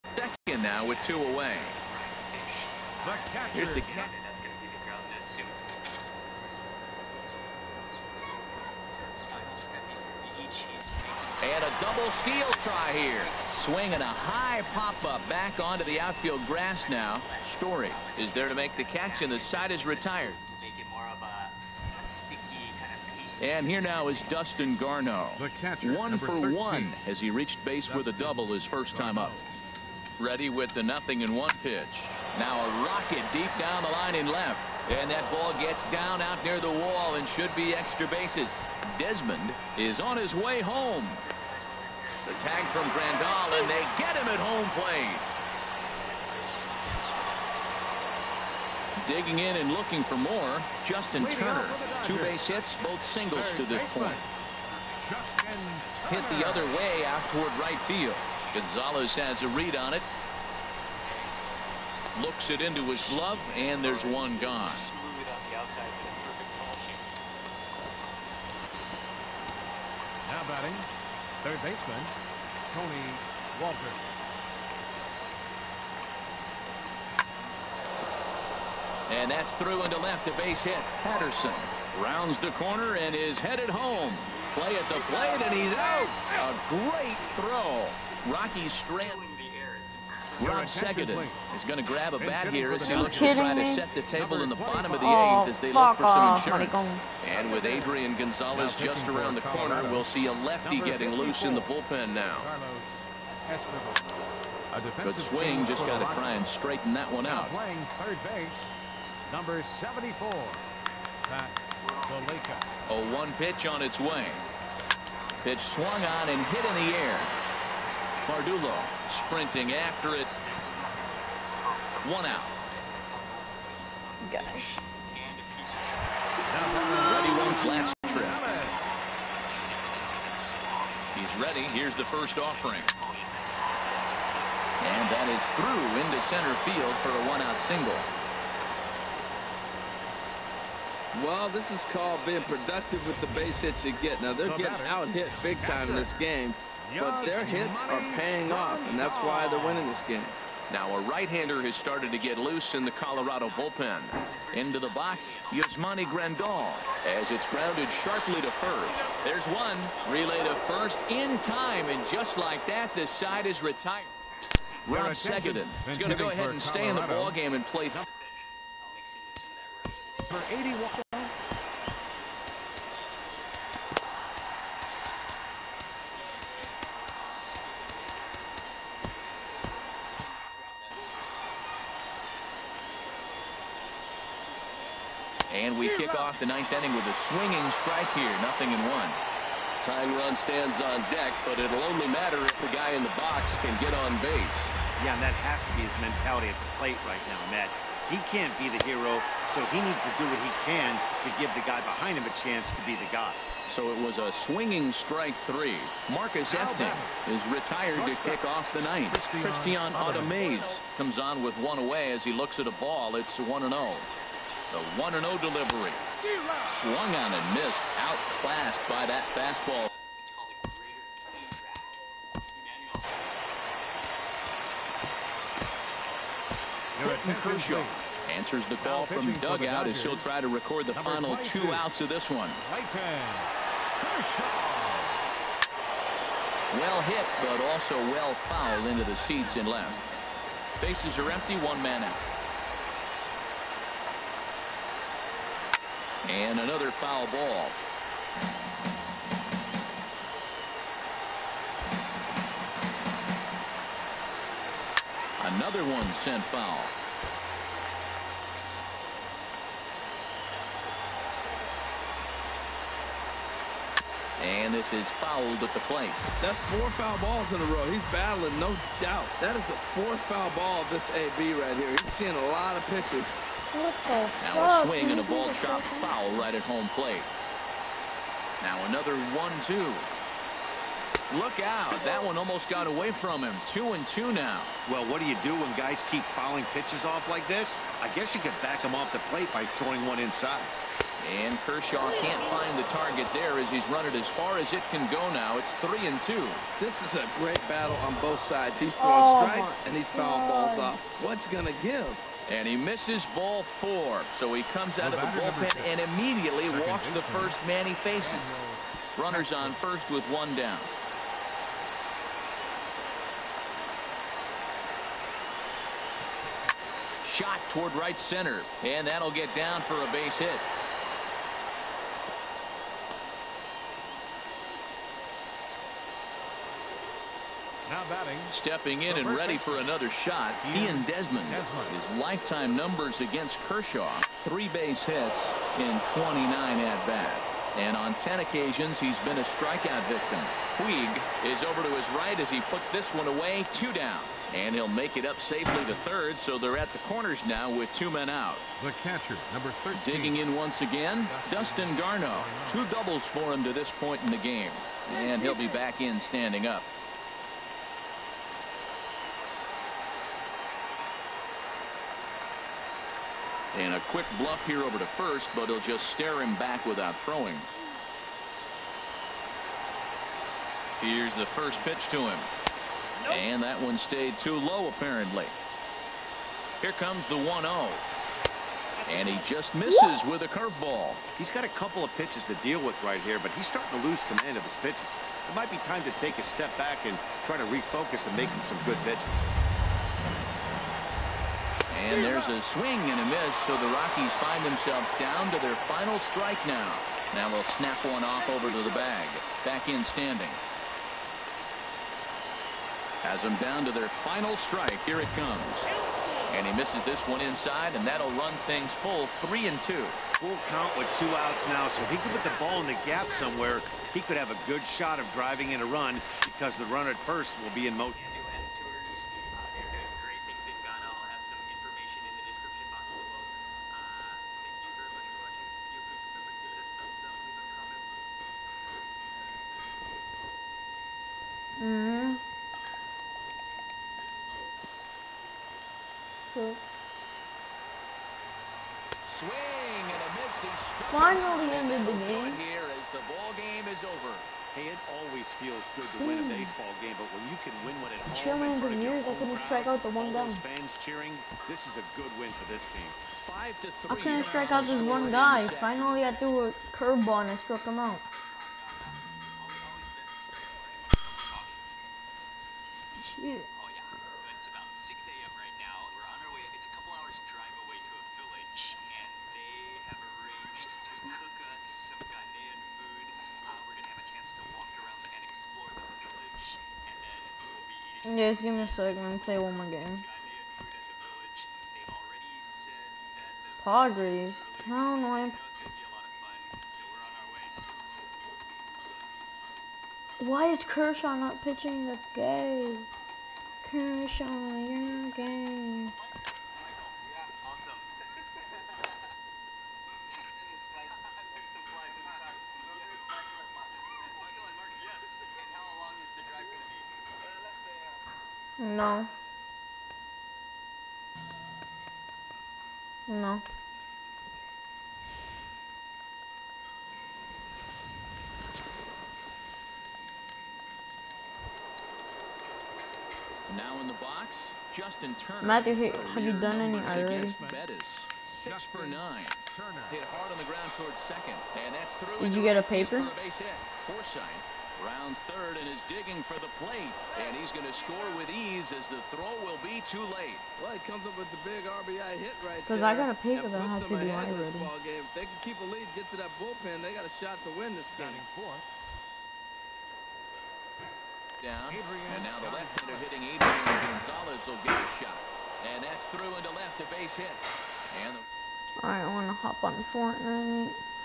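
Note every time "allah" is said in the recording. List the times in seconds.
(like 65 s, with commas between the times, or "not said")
not said.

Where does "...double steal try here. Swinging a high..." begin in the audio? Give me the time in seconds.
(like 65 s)
11 s.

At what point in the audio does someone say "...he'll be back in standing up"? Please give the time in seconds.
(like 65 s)
355 s.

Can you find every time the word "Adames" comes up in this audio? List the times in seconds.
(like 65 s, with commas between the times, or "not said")
209 s.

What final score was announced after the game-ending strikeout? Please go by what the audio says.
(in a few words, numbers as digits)
5 to 3.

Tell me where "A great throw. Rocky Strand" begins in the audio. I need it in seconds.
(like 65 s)
86 s.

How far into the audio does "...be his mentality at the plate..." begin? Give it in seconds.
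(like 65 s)
195 s.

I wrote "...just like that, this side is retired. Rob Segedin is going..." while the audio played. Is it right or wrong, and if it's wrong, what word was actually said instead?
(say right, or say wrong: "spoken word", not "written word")
right.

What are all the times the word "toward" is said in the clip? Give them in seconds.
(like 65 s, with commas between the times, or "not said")
57 s, 317 s, 530 s.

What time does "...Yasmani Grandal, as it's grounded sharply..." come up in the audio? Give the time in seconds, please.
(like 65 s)
155 s.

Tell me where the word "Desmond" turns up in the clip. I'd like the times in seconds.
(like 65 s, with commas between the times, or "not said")
38 s, 331 s.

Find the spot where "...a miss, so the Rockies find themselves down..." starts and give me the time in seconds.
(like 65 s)
393 s.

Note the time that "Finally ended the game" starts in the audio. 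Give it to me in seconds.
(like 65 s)
441 s.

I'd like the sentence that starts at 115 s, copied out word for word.
Pitch swung on and hit in the air.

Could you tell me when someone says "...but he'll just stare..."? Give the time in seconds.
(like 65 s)
365 s.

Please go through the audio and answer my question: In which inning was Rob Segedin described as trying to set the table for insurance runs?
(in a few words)
8th.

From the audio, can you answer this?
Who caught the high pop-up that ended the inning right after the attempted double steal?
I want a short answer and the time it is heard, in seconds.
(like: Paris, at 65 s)
Story, at 17 s.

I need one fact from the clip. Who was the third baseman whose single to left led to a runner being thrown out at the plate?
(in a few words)
Tony Walker.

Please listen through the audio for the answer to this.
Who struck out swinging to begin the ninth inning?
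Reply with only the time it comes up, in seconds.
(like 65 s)
206 s.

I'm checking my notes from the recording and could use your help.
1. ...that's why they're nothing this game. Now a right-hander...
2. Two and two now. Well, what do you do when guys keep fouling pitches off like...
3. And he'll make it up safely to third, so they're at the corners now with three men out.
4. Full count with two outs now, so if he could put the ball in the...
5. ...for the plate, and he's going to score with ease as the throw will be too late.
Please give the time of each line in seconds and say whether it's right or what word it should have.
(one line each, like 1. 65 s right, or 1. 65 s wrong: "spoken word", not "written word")
1. 148 s wrong: "winning", not "nothing"
2. 283 s right
3. 344 s wrong: "two", not "three"
4. 410 s right
5. 536 s right.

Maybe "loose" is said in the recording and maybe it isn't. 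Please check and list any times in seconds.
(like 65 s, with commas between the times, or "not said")
101 s, 152 s.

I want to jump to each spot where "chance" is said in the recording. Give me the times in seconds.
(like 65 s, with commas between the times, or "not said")
202 s, 474 s.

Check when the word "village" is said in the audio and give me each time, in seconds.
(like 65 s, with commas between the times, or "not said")
468 s, 476 s.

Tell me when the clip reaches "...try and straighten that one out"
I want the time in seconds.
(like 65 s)
106 s.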